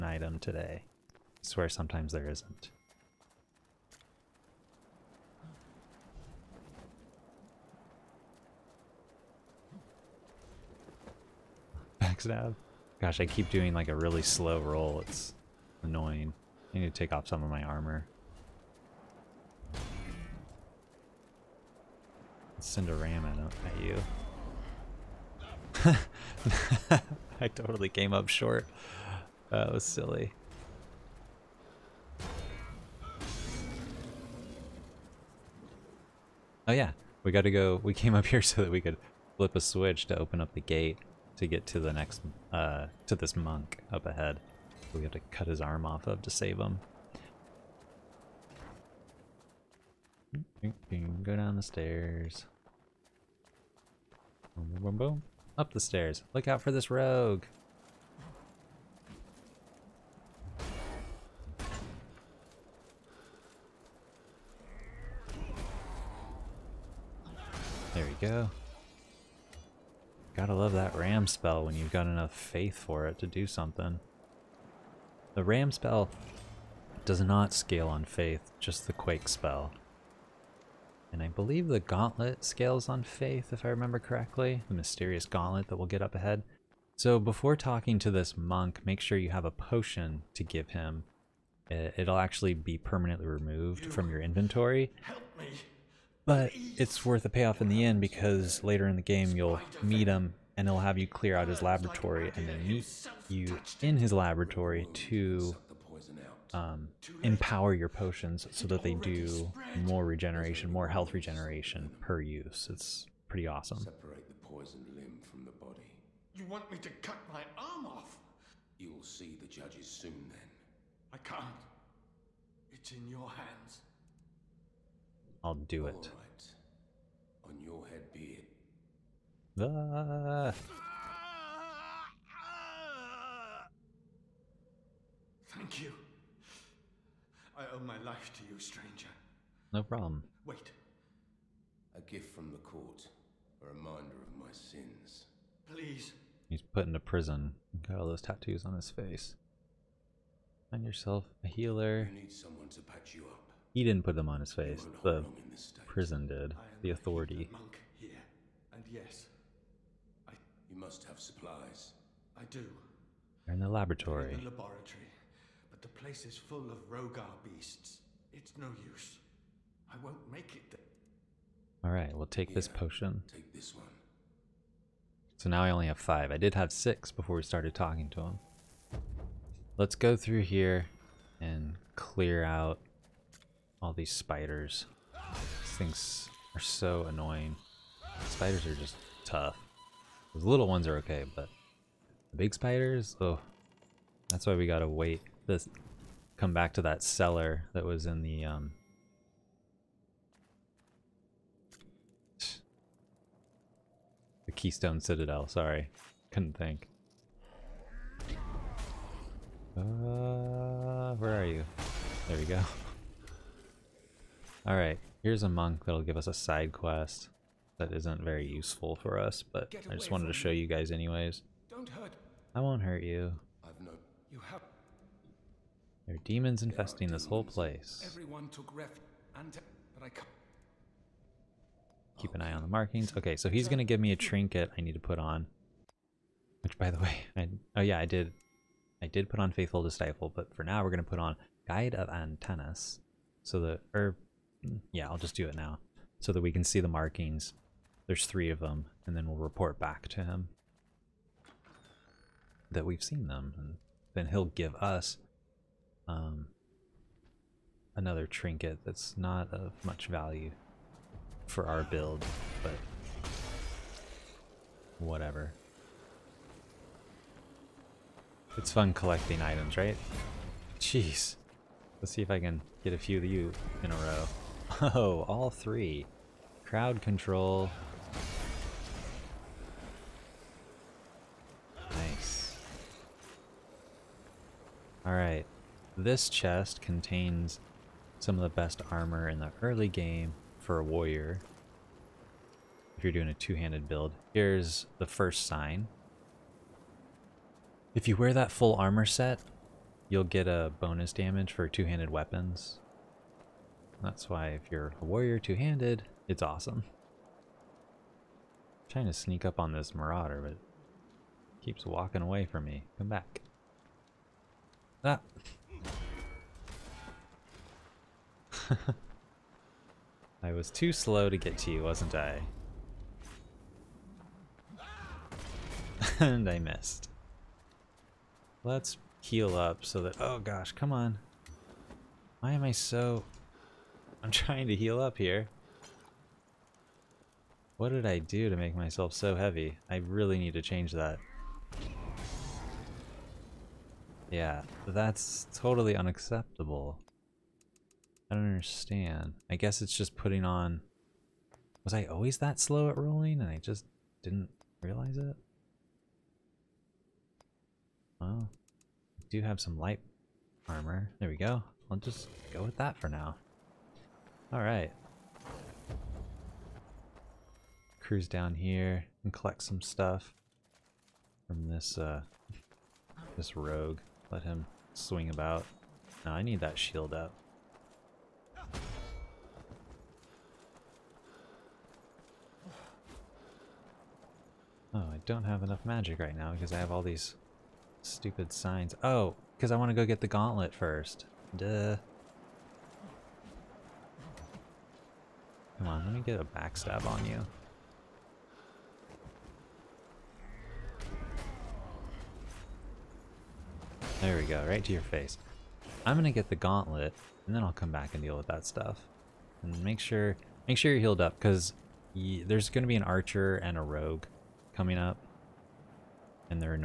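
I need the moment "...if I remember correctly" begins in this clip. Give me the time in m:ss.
1:23.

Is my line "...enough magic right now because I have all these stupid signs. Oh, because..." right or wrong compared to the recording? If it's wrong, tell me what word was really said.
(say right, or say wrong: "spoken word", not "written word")
right.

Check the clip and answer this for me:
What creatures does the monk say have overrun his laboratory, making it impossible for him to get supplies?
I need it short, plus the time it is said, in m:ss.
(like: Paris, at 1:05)
Rhogar beasts, at 2:46.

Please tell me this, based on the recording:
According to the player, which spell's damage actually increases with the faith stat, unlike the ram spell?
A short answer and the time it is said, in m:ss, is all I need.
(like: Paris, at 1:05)
Quake, at 1:18.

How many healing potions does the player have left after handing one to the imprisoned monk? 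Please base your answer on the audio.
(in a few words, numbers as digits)
5.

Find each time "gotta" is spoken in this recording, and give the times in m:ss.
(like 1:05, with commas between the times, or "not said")
0:37, 1:10, 3:14.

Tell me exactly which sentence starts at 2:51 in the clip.
All right, we'll take yeah, this potion.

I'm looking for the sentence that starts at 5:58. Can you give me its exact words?
Well, I do have some light armor.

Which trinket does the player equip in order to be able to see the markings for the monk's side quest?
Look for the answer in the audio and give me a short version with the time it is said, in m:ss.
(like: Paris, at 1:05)
Guide of Antanas, at 4:01.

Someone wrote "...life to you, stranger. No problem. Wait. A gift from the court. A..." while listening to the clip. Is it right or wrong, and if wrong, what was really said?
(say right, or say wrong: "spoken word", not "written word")
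right.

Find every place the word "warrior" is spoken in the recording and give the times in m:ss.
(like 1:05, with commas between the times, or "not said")
4:50, 5:05.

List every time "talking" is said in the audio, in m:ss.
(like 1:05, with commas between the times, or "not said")
1:27, 2:57.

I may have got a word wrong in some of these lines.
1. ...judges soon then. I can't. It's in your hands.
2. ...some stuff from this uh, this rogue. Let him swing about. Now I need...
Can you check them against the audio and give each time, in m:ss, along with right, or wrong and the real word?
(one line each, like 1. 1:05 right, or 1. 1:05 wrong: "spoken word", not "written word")
1. 1:59 right
2. 6:09 right.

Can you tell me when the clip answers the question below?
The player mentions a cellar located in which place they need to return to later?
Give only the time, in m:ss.
3:24.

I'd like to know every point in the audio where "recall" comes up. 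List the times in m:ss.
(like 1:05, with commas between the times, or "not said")
not said.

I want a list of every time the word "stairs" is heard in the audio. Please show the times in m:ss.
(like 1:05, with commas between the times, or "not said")
0:51, 0:55.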